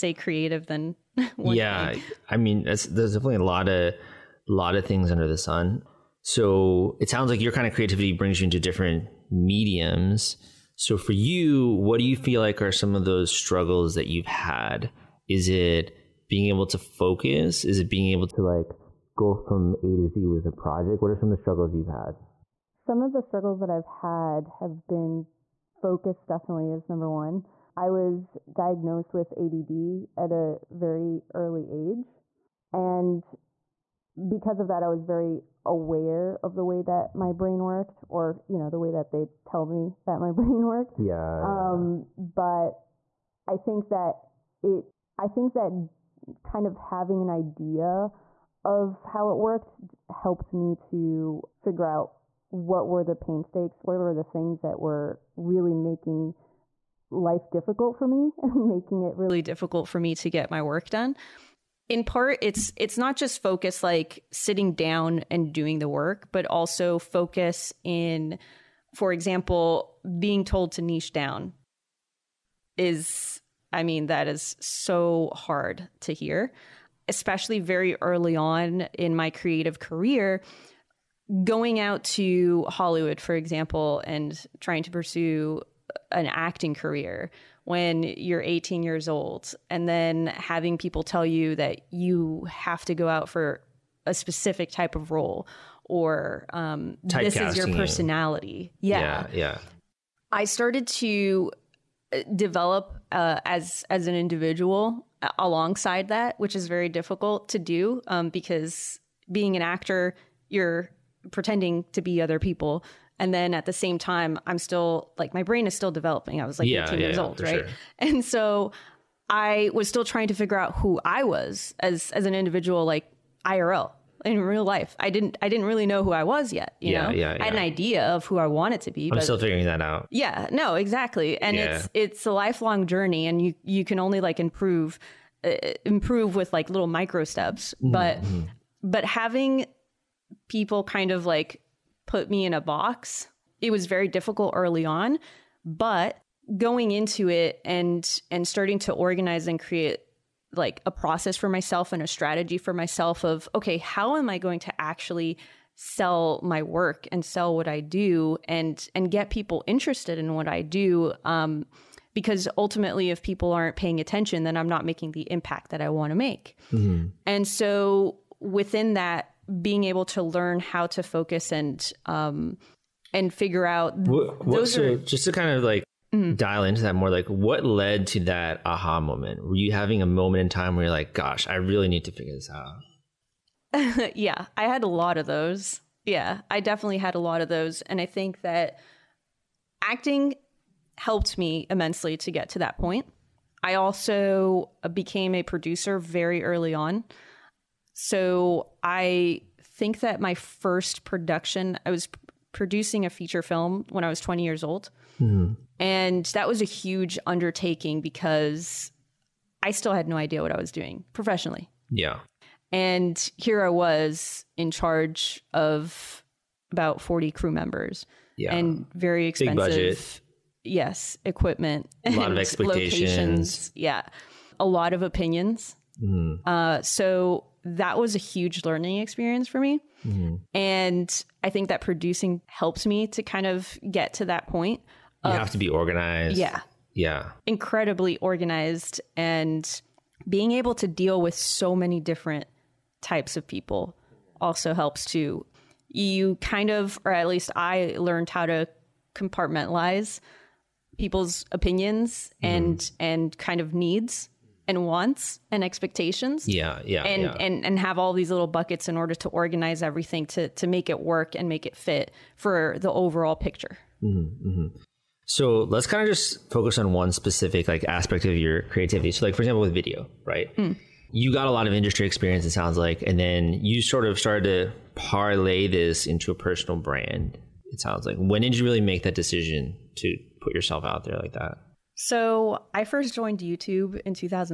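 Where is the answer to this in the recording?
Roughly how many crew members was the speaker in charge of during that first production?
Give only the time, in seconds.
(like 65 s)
217 s.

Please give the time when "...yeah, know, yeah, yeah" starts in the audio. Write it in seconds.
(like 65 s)
126 s.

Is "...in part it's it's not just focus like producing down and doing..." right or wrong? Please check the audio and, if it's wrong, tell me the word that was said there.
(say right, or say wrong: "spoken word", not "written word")
wrong: "sitting", not "producing".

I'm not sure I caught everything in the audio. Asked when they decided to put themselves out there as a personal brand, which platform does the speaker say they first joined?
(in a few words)
YouTube.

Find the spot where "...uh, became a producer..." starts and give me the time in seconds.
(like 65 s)
194 s.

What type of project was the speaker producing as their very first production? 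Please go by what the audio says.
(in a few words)
Feature film.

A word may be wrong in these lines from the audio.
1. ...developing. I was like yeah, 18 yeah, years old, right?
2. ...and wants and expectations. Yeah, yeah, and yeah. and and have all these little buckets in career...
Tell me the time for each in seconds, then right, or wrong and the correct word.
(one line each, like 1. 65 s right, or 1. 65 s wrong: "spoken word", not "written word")
1. 115 s right
2. 254 s wrong: "order", not "career".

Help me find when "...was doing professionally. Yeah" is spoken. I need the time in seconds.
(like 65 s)
210 s.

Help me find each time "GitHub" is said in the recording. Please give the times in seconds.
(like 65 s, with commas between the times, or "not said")
not said.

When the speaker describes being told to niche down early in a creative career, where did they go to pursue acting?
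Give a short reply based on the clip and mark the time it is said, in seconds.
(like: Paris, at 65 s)
Hollywood, at 82 s.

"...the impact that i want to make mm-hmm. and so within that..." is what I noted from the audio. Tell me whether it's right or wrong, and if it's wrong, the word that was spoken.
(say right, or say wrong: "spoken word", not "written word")
right.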